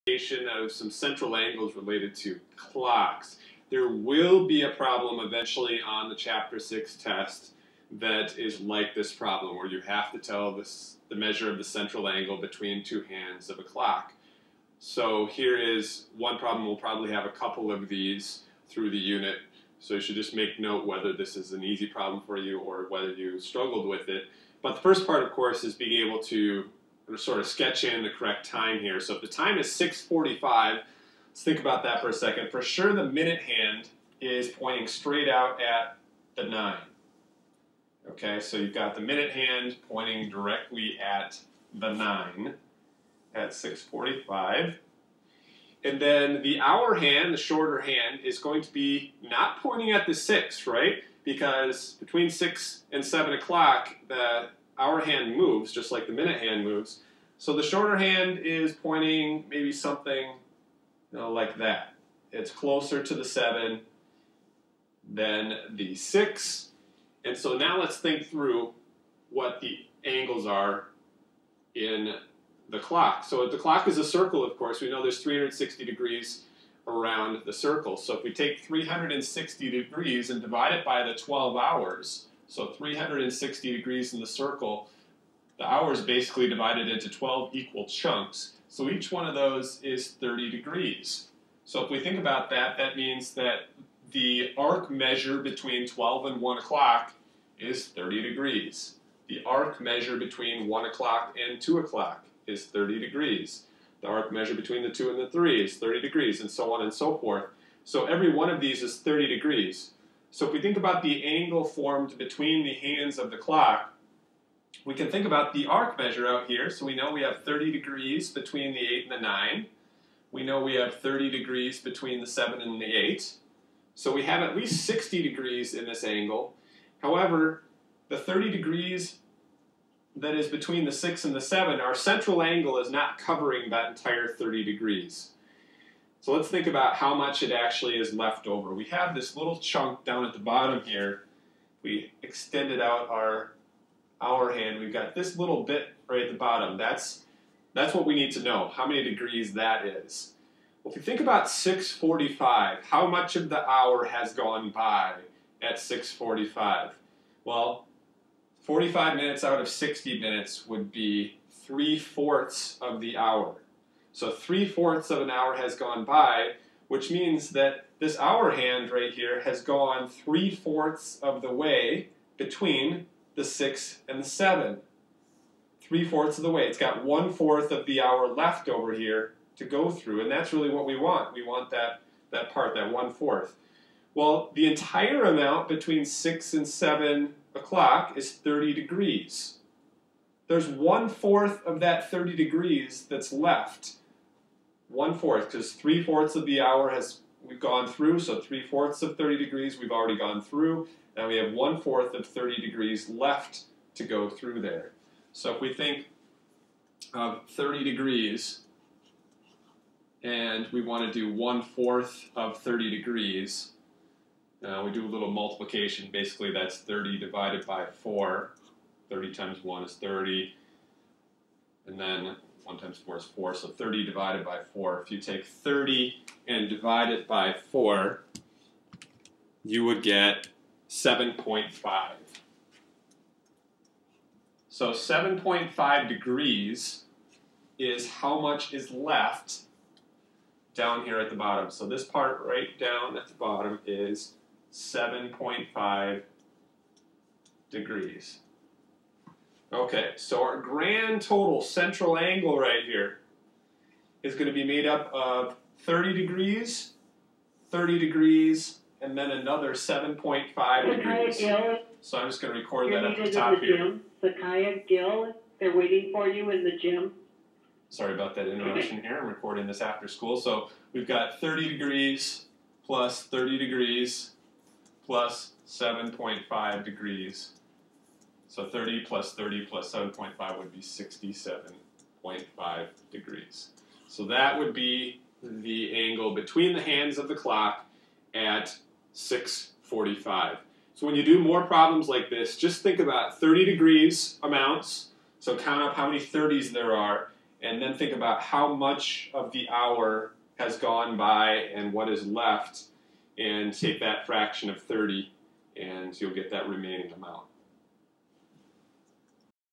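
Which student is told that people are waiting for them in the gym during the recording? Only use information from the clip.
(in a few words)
Sakaya Gill.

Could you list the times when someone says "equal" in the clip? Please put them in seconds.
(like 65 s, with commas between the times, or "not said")
87 s.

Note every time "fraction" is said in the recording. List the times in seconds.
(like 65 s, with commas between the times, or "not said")
304 s.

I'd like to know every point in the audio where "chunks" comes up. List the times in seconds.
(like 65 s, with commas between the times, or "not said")
87 s, 139 s.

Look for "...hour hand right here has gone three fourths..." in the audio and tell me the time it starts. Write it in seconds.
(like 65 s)
168 s.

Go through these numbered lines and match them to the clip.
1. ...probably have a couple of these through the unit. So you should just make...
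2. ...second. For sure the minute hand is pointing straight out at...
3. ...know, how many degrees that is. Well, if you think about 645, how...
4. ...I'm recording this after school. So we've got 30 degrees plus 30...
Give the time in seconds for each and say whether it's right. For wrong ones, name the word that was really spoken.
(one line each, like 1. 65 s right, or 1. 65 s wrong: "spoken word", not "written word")
1. 16 s right
2. 32 s right
3. 148 s right
4. 269 s right.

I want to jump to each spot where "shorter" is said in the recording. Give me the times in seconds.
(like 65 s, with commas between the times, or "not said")
47 s, 57 s.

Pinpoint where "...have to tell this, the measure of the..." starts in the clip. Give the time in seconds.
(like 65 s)
9 s.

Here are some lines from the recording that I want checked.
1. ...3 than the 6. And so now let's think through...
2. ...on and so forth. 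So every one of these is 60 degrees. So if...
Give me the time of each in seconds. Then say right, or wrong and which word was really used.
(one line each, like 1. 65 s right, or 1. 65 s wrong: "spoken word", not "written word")
1. 63 s wrong: "7", not "3"
2. 106 s wrong: "30", not "60".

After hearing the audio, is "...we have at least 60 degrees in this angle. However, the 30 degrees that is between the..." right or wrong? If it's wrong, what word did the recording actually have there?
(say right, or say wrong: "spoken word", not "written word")
right.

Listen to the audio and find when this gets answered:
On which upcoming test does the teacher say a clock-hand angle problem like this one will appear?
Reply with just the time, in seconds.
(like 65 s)
6 s.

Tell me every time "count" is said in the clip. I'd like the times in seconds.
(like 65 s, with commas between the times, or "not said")
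295 s.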